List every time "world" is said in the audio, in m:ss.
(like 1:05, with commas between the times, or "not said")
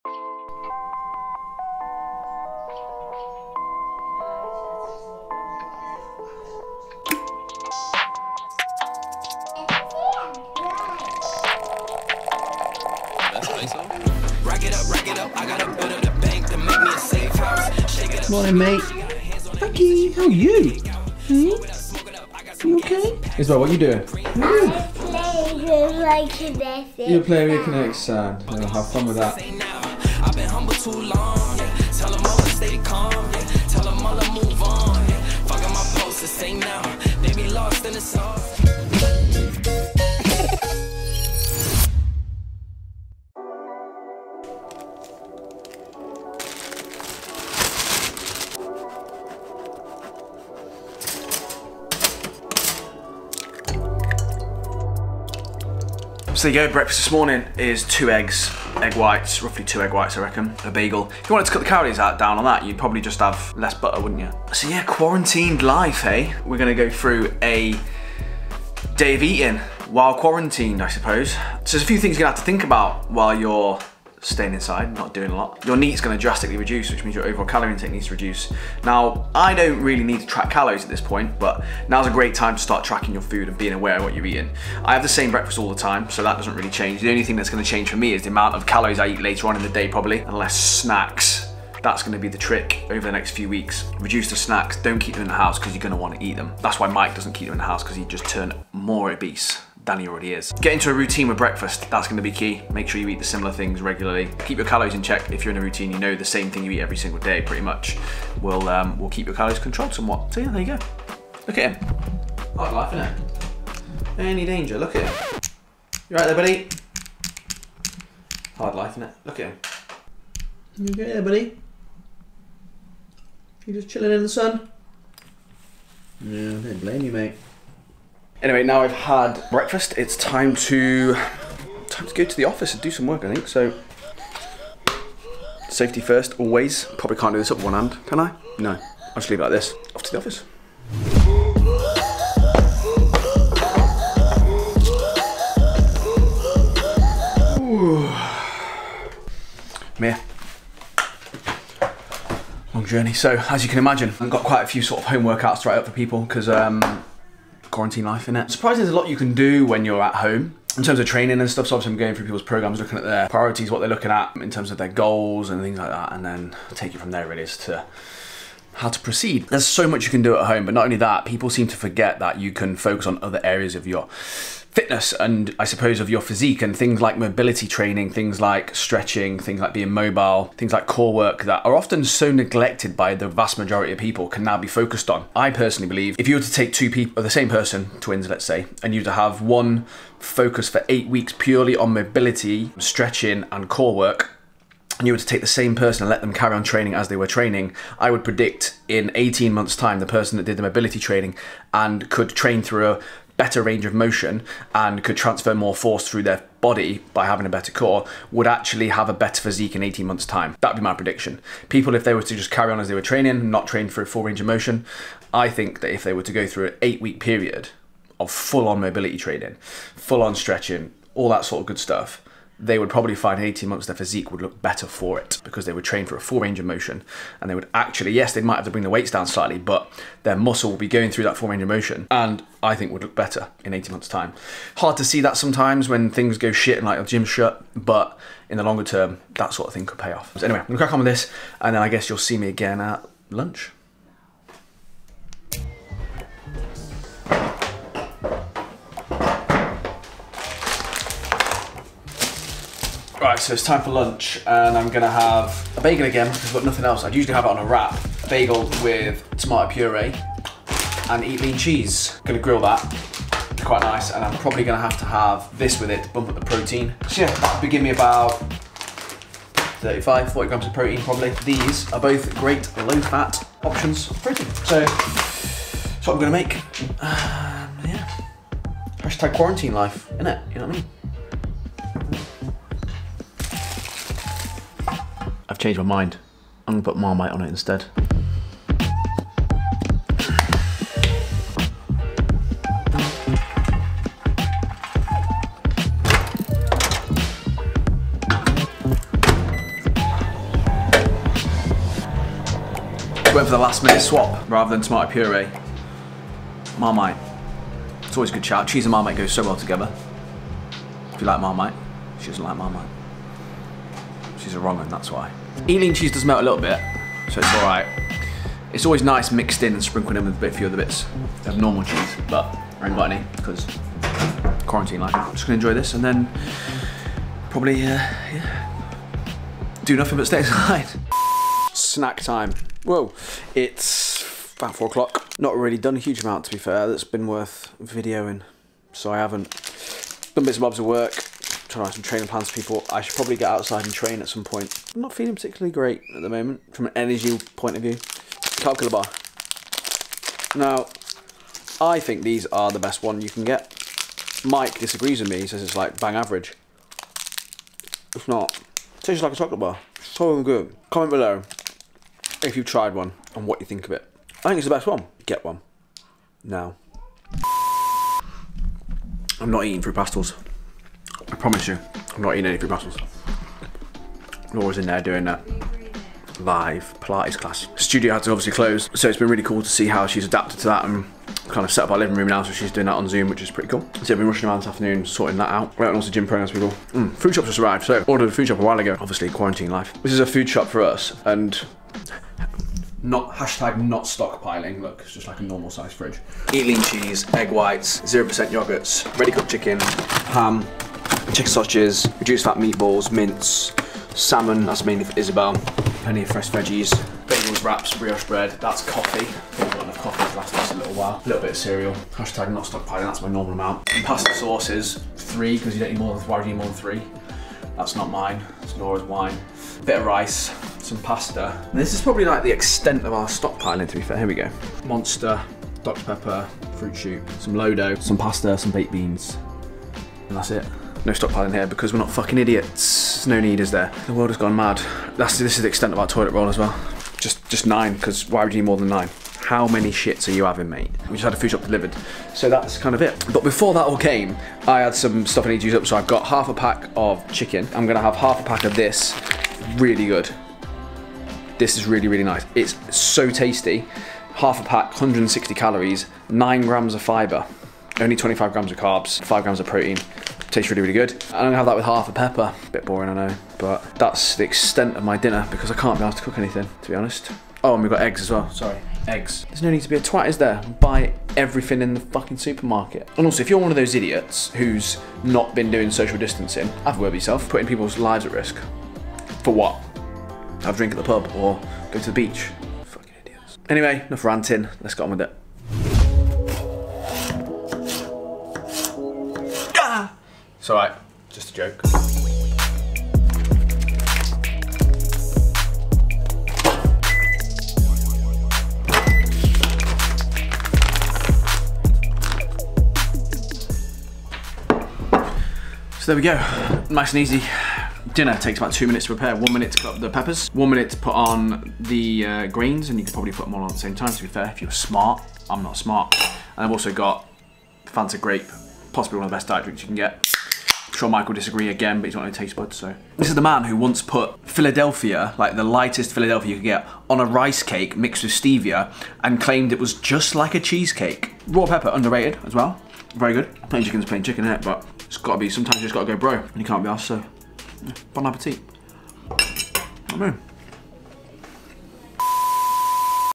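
7:14.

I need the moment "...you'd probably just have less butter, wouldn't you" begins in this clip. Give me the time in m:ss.
1:02.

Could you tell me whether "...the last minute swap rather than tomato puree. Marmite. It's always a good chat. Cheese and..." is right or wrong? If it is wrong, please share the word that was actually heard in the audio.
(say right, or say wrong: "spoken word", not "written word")
right.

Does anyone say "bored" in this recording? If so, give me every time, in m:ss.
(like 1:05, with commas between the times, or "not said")
not said.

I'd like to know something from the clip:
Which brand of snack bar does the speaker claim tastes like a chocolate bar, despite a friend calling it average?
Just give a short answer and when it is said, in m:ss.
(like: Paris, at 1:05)
Carb Killa, at 5:47.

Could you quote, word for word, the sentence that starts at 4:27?
So yeah, that'll give me about 35, 40 grams of protein probably.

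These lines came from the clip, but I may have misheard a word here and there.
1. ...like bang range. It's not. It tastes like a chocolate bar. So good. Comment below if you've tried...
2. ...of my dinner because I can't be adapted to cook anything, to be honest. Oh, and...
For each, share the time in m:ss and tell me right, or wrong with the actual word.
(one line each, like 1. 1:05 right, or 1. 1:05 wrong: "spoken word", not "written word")
1. 5:55 wrong: "average", not "range"
2. 7:44 wrong: "asked", not "adapted".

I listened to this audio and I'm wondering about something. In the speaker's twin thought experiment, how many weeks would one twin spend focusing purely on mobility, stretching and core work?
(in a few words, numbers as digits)
8.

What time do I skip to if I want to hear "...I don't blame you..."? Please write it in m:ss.
2:06.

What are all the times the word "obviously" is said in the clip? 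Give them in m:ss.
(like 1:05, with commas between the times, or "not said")
2:41, 6:18, 6:29.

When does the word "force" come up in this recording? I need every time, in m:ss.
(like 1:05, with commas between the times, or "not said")
3:25.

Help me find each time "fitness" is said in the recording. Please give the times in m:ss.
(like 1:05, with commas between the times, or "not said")
2:54.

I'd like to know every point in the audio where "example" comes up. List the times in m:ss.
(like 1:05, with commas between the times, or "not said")
not said.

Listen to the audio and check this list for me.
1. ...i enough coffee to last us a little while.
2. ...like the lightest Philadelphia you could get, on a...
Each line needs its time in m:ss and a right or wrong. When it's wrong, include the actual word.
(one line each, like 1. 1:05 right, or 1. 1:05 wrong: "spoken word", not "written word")
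1. 6:49 right
2. 8:45 right.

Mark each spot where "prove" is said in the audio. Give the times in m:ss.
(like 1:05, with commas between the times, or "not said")
not said.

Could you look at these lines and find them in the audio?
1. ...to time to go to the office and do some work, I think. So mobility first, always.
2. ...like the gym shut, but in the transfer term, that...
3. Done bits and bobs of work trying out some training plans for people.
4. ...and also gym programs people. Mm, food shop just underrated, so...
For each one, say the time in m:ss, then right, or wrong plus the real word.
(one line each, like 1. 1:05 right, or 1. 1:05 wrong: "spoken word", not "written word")
1. 2:10 wrong: "safety", not "mobility"
2. 3:56 wrong: "longer", not "transfer"
3. 5:40 right
4. 6:25 wrong: "arrived", not "underrated".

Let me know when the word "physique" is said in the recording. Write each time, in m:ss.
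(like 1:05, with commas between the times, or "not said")
2:56, 3:29, 3:43.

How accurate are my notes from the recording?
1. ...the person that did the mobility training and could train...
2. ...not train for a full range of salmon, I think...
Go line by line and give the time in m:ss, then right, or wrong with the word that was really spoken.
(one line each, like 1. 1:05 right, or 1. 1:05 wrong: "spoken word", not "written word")
1. 3:19 right
2. 3:33 wrong: "motion", not "salmon".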